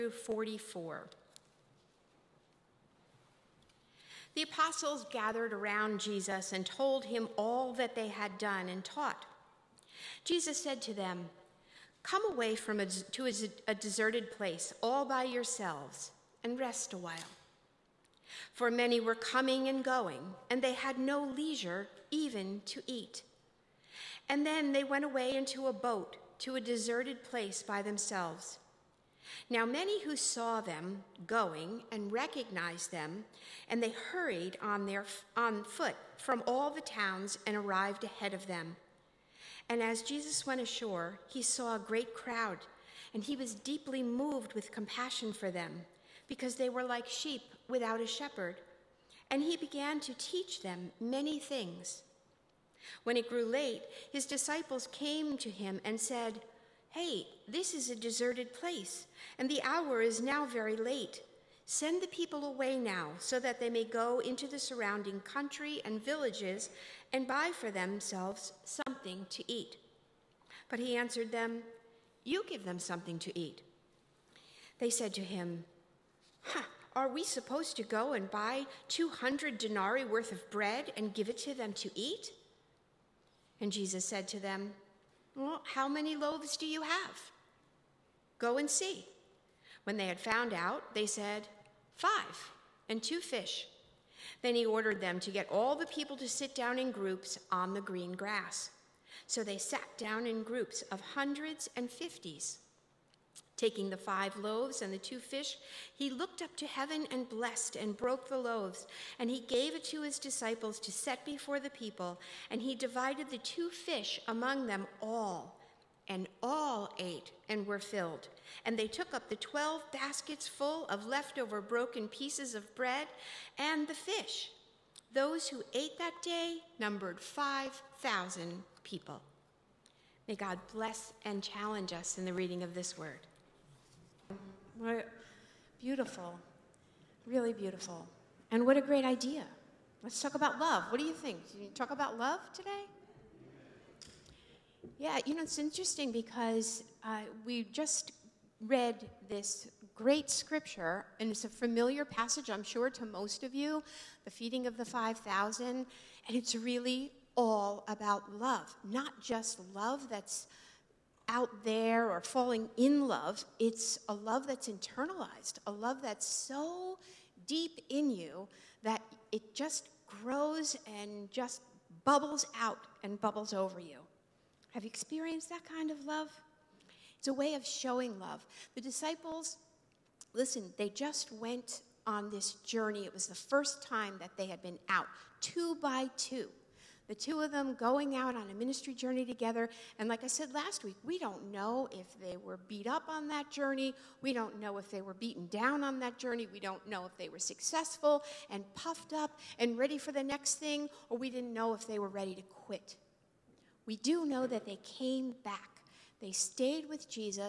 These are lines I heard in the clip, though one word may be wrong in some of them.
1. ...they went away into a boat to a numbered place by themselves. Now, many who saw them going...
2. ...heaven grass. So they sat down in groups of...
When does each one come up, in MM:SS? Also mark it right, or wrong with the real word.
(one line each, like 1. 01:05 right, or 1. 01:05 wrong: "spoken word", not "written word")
1. 00:24 wrong: "deserted", not "numbered"
2. 01:37 wrong: "green", not "heaven".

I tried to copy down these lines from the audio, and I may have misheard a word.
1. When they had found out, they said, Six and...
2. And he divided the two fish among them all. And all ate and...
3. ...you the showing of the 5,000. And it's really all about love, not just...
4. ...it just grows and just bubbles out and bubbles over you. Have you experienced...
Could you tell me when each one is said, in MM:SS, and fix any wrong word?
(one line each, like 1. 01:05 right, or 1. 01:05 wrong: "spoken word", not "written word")
1. 01:29 wrong: "Five", not "Six"
2. 01:52 right
3. 02:33 wrong: "feeding", not "showing"
4. 02:49 right.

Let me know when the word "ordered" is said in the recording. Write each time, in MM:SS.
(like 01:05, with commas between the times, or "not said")
01:34.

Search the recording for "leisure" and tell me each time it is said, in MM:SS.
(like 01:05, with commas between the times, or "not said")
00:21.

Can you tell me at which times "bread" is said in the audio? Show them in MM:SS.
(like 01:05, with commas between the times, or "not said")
01:20, 02:02.